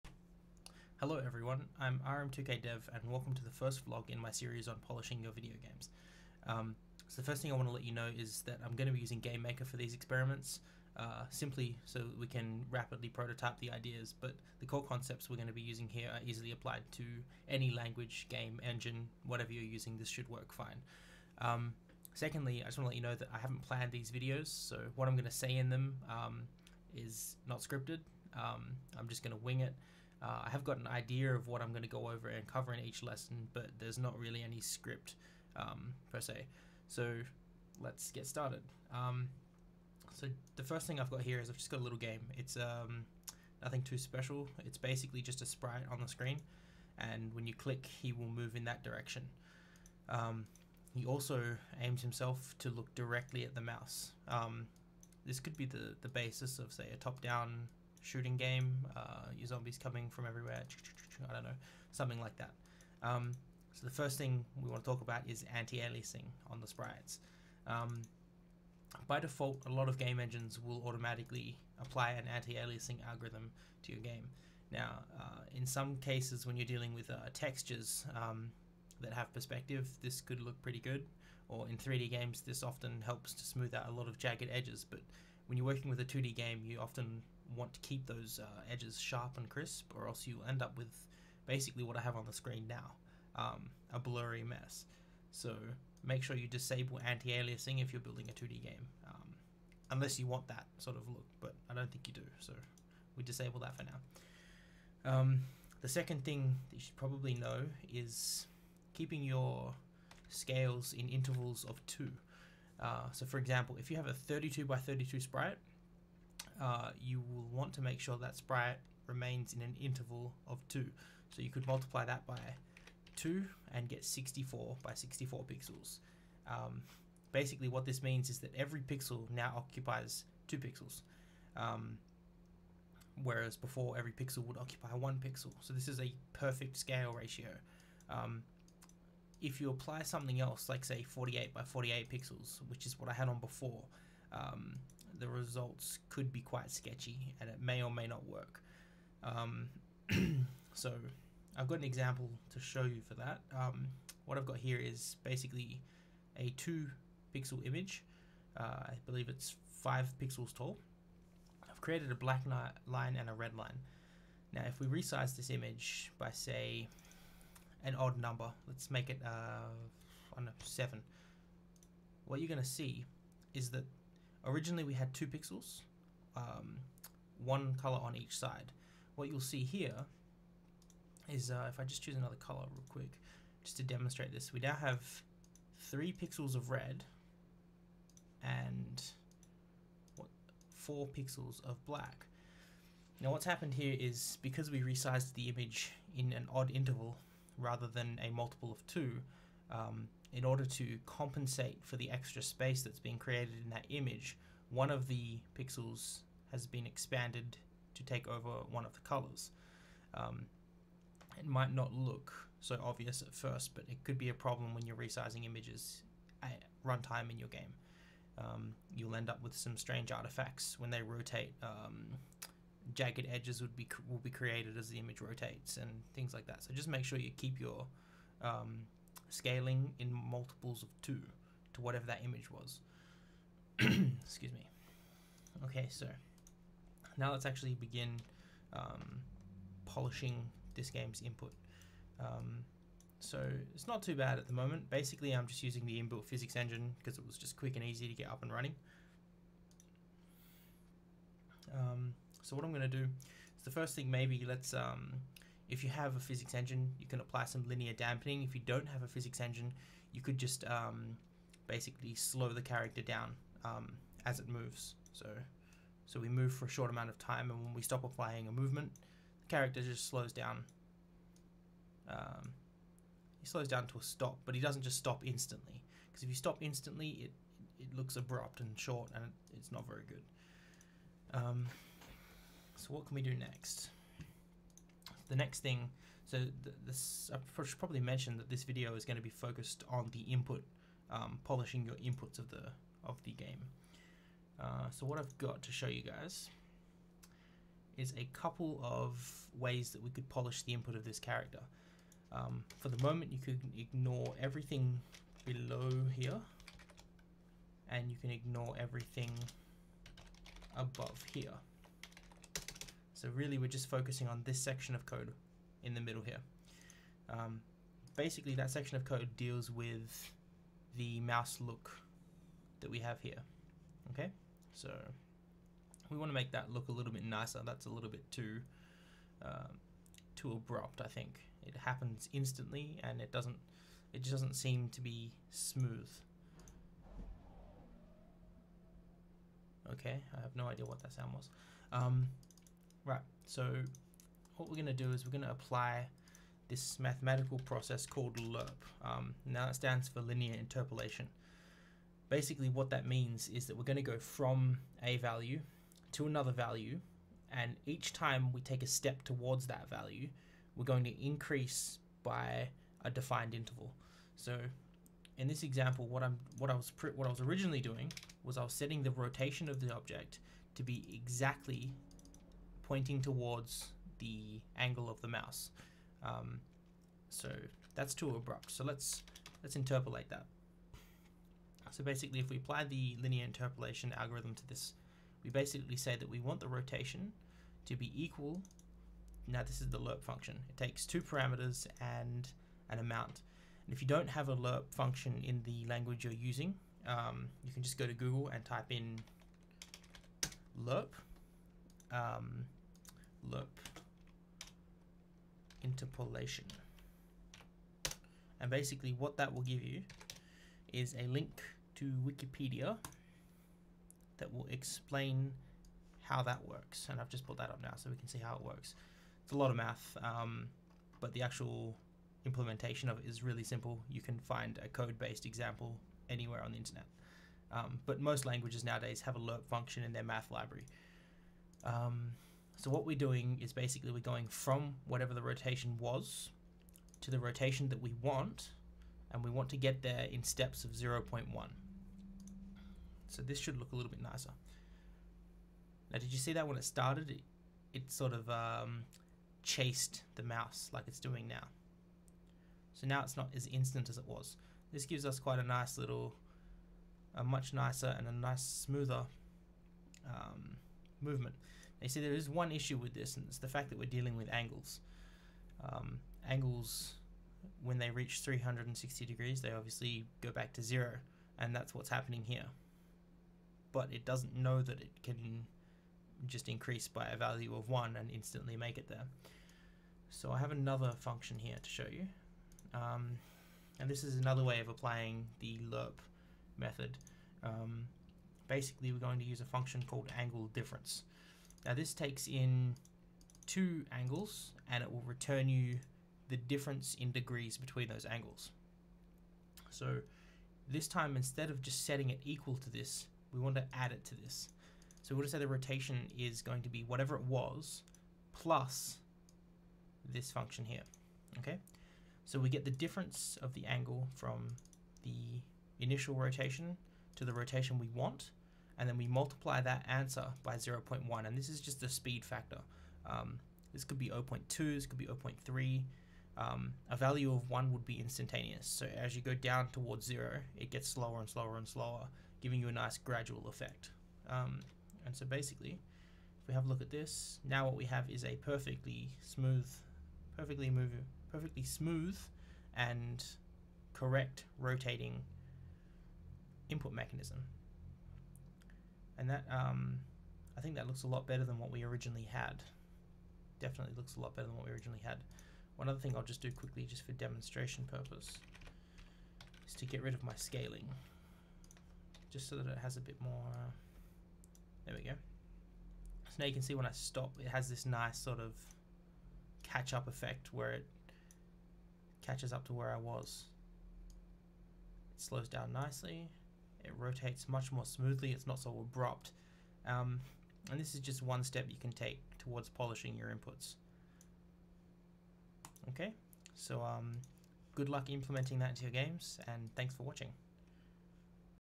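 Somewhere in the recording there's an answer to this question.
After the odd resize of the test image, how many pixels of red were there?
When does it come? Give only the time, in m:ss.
3:05.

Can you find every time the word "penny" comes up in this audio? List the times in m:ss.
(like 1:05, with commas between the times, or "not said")
not said.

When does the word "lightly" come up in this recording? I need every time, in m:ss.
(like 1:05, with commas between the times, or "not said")
not said.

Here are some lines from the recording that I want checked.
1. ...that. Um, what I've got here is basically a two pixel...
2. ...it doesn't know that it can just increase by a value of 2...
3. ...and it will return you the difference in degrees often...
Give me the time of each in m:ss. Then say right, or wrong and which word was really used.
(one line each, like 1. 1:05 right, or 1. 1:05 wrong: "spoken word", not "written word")
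1. 2:33 right
2. 7:54 wrong: "1", not "2"
3. 8:14 wrong: "between", not "often".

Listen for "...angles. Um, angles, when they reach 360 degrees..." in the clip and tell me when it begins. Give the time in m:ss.
7:44.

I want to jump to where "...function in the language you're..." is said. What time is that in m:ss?
6:34.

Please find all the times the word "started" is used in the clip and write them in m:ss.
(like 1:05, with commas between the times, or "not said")
0:38, 7:26.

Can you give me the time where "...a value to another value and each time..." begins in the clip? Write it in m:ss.
5:55.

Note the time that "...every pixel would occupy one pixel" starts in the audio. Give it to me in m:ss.
2:13.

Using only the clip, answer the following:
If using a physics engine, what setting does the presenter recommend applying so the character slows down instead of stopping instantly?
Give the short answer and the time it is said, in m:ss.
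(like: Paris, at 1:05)
linear dampening, at 4:17.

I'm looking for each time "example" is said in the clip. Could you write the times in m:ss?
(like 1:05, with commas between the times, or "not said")
1:53, 2:31, 6:05, 7:05.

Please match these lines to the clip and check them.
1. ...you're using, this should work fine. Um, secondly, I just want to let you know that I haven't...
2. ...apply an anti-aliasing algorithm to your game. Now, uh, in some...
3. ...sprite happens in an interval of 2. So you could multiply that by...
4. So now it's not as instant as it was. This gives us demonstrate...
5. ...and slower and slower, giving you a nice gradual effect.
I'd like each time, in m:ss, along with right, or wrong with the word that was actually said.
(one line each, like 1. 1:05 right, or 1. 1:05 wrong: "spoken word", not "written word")
1. 0:19 right
2. 1:11 right
3. 1:58 wrong: "remains", not "happens"
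4. 7:32 wrong: "quite", not "demonstrate"
5. 8:51 right.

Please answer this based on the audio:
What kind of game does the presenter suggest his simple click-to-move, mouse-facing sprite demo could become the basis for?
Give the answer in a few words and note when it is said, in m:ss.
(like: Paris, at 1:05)
top-down shooting game, at 0:56.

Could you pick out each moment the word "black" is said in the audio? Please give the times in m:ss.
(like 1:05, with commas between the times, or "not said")
2:42, 3:11.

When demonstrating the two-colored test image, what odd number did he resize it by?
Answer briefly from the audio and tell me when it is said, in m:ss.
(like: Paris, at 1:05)
7, at 2:50.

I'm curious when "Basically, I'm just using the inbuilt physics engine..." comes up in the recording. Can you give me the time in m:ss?
4:04.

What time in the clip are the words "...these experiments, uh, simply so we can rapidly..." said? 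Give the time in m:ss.
0:09.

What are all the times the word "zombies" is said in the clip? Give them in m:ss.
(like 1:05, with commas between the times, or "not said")
0:59.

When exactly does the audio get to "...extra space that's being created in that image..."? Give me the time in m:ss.
3:22.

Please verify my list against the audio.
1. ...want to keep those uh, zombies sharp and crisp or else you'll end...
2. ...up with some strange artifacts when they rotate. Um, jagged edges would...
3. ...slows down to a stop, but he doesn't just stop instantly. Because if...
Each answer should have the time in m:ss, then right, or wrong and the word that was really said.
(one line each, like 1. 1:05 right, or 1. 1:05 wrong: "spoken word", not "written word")
1. 1:27 wrong: "edges", not "zombies"
2. 3:39 right
3. 4:33 right.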